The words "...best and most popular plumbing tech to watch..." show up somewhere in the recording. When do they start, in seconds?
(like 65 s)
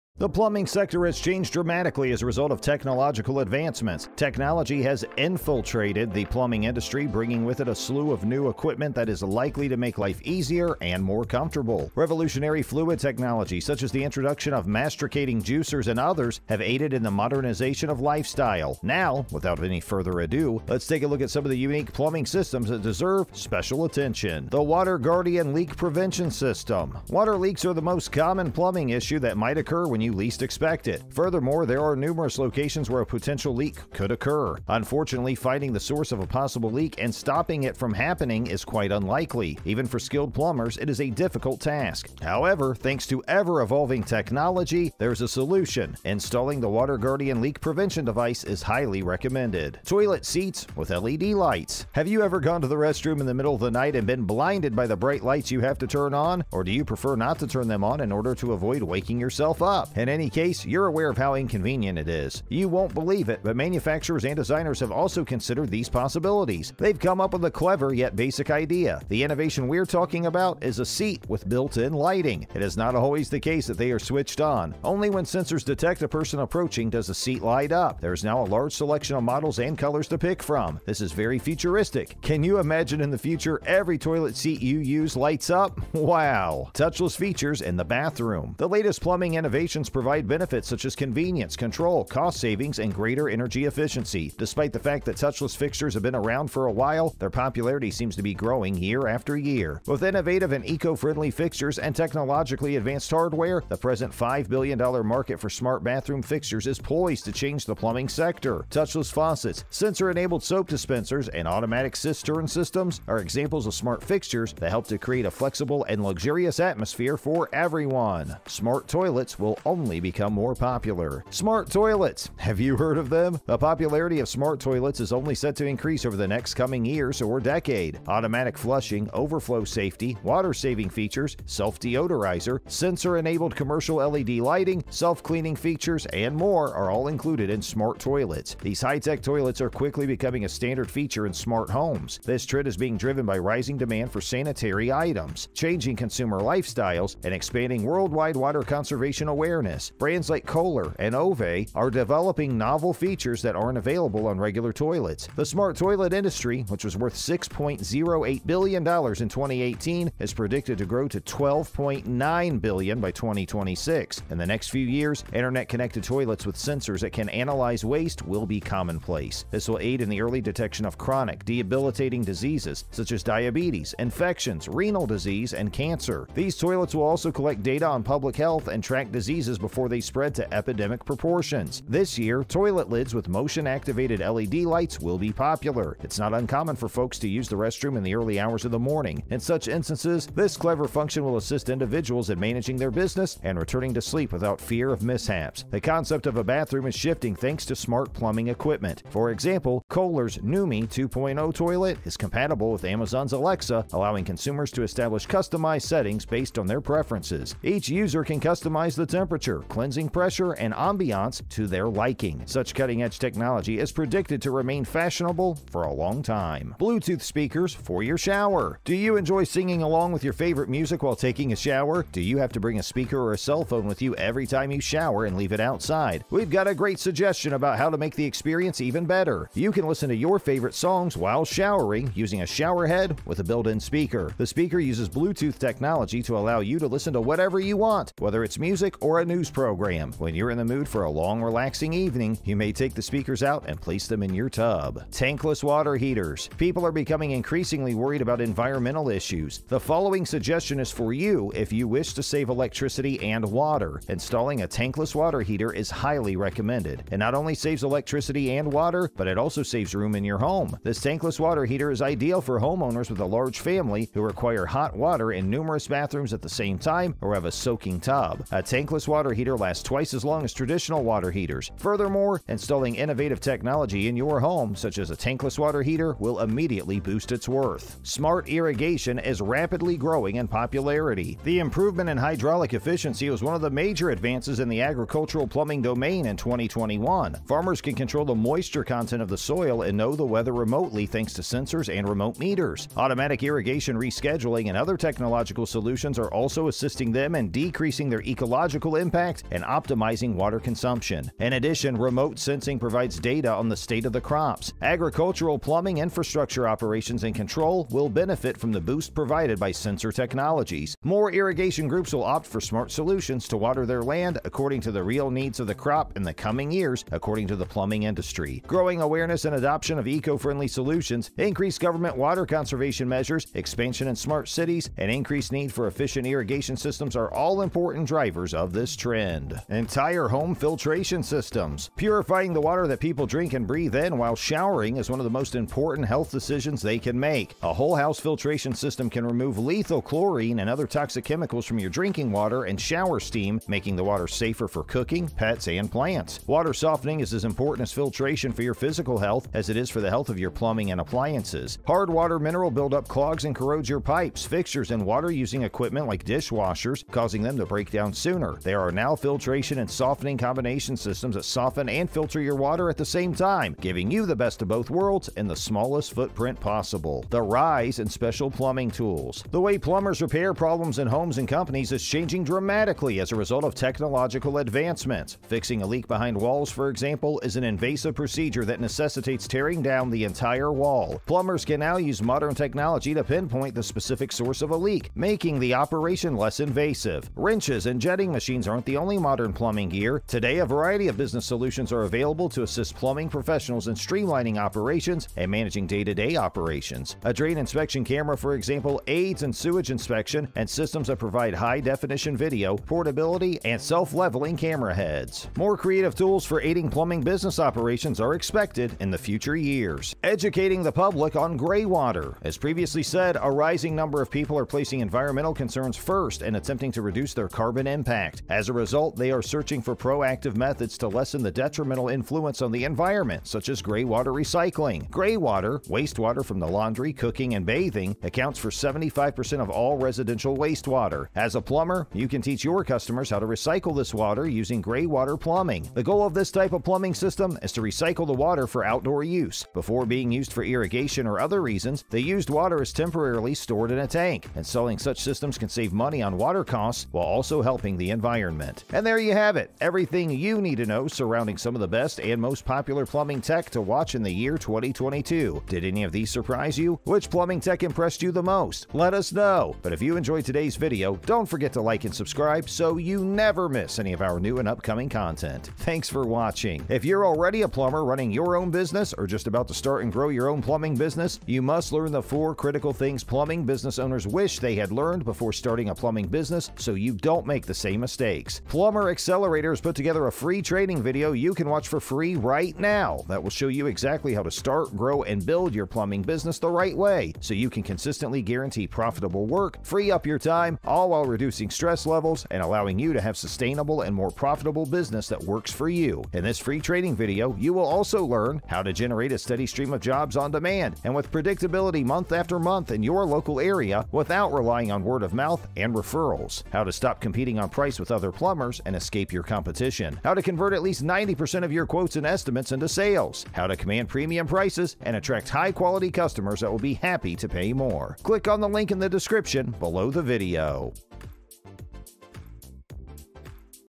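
451 s.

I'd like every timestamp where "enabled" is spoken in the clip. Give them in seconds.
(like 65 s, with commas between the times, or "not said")
109 s, 133 s.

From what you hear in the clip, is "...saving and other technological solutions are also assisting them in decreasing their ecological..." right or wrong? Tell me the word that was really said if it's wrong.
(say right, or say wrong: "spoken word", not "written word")
wrong: "rescheduling", not "saving".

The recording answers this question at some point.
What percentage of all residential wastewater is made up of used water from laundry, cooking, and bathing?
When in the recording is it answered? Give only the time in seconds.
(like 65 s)
428 s.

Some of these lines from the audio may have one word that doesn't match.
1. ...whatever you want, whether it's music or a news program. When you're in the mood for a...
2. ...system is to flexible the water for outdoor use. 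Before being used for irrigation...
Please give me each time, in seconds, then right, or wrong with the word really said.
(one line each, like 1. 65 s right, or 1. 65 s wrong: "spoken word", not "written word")
1. 237 s right
2. 437 s wrong: "recycle", not "flexible".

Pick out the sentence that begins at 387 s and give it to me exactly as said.
Wrenches and jetting machines aren't the only modern plumbing gear.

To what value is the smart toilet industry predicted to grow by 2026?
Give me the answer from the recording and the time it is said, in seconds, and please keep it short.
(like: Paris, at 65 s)
$12.9 billion, at 161 s.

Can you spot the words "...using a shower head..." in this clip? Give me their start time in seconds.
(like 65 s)
232 s.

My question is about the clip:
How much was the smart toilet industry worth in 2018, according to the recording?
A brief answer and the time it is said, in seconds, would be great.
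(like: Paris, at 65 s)
$6.08 billion, at 157 s.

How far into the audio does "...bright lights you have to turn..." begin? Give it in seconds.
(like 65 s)
54 s.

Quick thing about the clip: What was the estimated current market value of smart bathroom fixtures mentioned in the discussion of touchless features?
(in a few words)
$5 billion.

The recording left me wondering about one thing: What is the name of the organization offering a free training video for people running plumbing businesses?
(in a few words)
Plumber Accelerator.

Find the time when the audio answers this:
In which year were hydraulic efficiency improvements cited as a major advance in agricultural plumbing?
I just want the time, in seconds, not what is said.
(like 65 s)
286 s.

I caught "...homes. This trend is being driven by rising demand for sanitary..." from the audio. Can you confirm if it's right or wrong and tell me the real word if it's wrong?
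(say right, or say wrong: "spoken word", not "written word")
right.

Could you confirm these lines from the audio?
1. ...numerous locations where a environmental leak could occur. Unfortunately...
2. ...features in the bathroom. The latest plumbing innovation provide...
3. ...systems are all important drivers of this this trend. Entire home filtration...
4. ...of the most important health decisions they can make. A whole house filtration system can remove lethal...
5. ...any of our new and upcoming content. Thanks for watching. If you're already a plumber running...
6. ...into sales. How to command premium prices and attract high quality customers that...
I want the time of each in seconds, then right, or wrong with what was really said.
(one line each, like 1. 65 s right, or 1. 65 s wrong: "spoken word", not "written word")
1. 31 s wrong: "potential", not "environmental"
2. 87 s right
3. 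326 s right
4. 335 s right
5. 463 s right
6. 512 s right.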